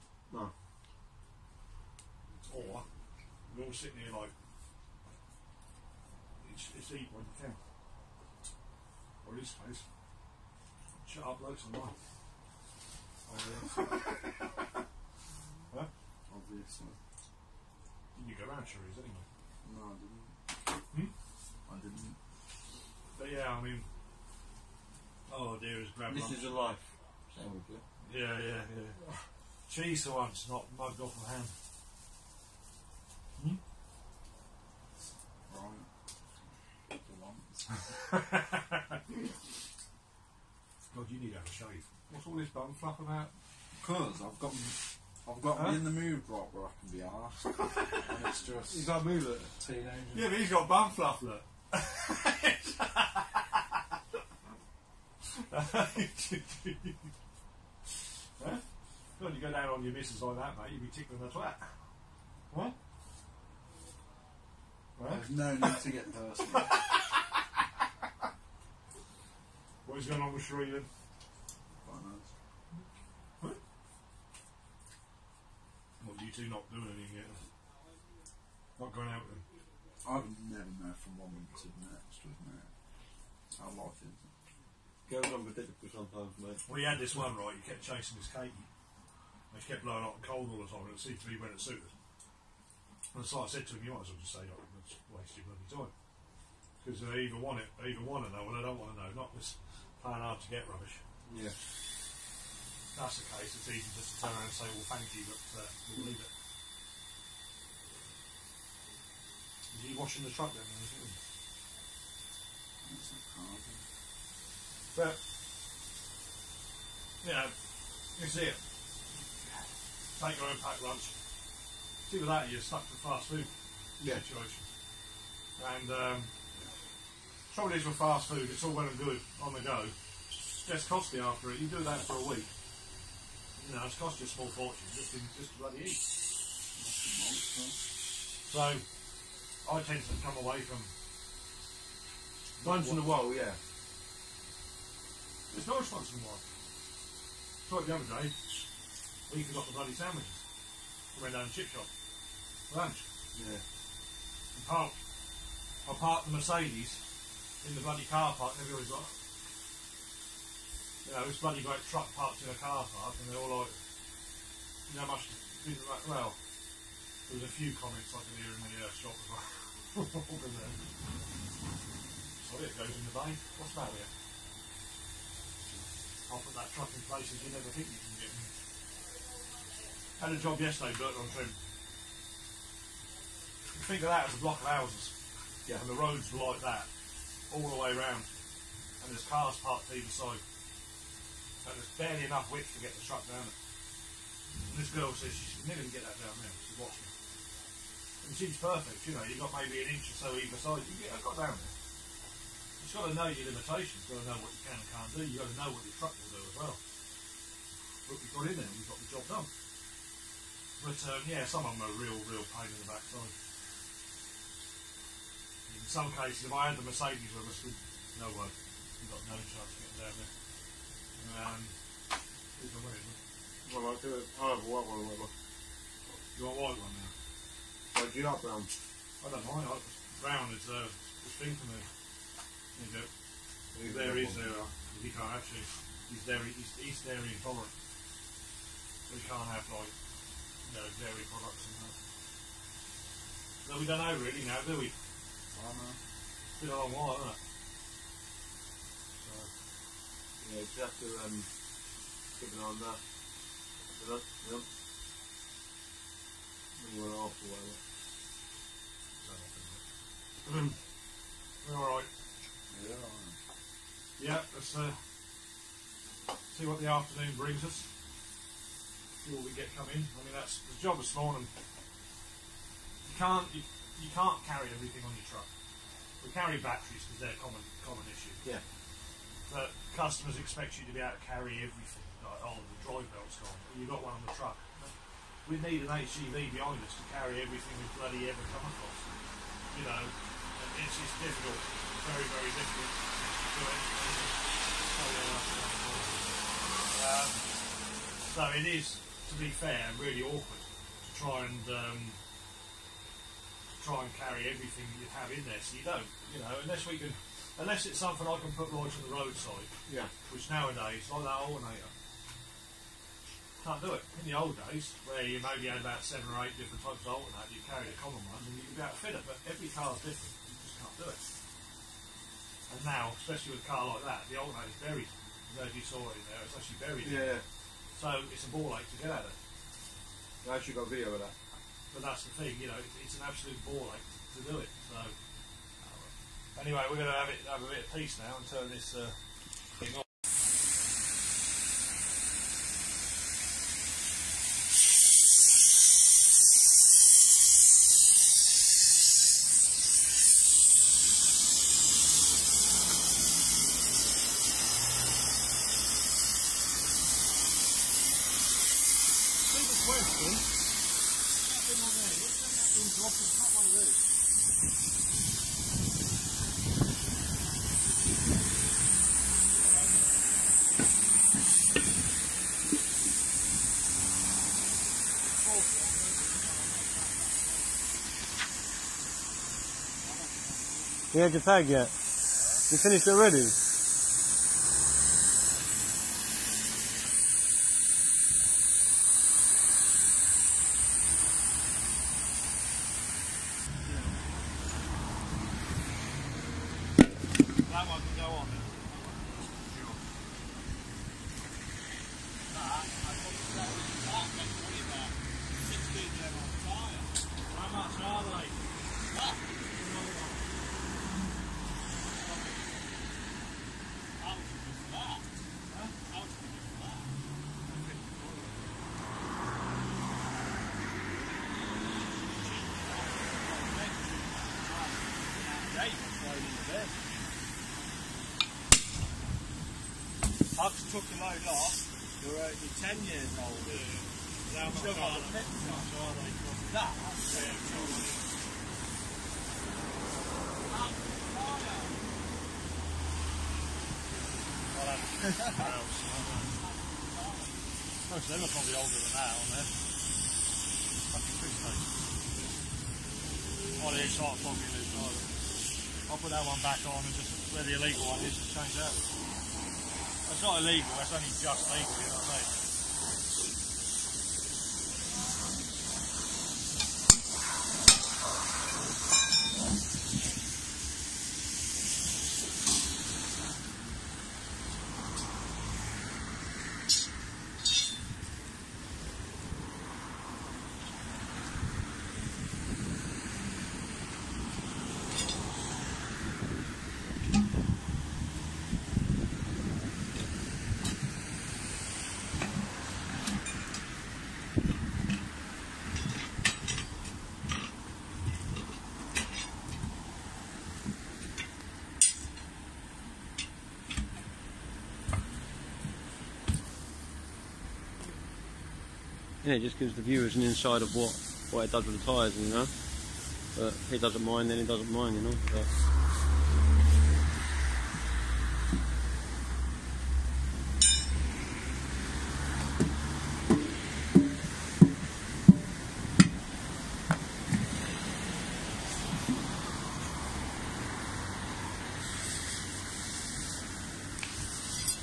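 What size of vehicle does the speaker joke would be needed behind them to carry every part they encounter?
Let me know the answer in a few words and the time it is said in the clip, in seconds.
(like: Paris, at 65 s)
HGV, at 285 s.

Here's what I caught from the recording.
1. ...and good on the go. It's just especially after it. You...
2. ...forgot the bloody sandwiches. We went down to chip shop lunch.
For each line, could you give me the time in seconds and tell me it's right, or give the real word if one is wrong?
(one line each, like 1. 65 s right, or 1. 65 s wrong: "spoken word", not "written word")
1. 128 s wrong: "costly", not "especially"
2. 149 s right.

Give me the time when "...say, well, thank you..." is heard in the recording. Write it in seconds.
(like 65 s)
104 s.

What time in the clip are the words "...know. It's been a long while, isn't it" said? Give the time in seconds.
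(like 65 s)
245 s.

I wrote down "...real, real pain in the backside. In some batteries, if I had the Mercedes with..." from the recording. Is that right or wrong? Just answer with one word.
wrong.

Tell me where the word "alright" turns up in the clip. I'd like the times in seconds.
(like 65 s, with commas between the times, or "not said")
261 s.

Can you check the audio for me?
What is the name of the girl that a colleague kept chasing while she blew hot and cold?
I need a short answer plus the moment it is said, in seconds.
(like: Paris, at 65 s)
Katie, at 88 s.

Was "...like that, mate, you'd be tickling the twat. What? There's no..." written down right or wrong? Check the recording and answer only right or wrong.
right.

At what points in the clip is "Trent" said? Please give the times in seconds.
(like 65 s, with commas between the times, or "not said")
181 s.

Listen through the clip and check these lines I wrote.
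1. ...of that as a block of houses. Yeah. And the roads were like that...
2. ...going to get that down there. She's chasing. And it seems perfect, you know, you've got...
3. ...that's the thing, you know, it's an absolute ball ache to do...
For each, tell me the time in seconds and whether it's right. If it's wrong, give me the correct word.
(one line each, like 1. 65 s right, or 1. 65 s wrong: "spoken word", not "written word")
1. 184 s right
2. 195 s wrong: "watching", not "chasing"
3. 332 s right.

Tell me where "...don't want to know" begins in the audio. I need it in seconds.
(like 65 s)
98 s.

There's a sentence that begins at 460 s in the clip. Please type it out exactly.
It's not illegal, it's only just legal, you know what I mean?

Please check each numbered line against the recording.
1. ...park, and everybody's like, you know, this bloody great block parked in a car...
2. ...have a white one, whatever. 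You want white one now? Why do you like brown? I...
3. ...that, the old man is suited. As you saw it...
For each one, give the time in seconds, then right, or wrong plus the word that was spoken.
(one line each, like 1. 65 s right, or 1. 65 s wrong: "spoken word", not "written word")
1. 158 s wrong: "truck", not "block"
2. 224 s right
3. 324 s wrong: "buried", not "suited".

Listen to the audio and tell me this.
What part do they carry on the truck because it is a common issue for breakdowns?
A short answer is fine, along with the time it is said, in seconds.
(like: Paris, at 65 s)
Batteries, at 276 s.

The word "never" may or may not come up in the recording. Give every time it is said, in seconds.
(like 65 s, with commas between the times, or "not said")
80 s, 177 s, 195 s.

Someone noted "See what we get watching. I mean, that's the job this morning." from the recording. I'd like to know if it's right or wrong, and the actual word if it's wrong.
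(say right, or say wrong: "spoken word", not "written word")
wrong: "coming", not "watching".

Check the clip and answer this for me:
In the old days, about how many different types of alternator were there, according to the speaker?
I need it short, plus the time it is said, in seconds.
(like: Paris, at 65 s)
7 or 8, at 316 s.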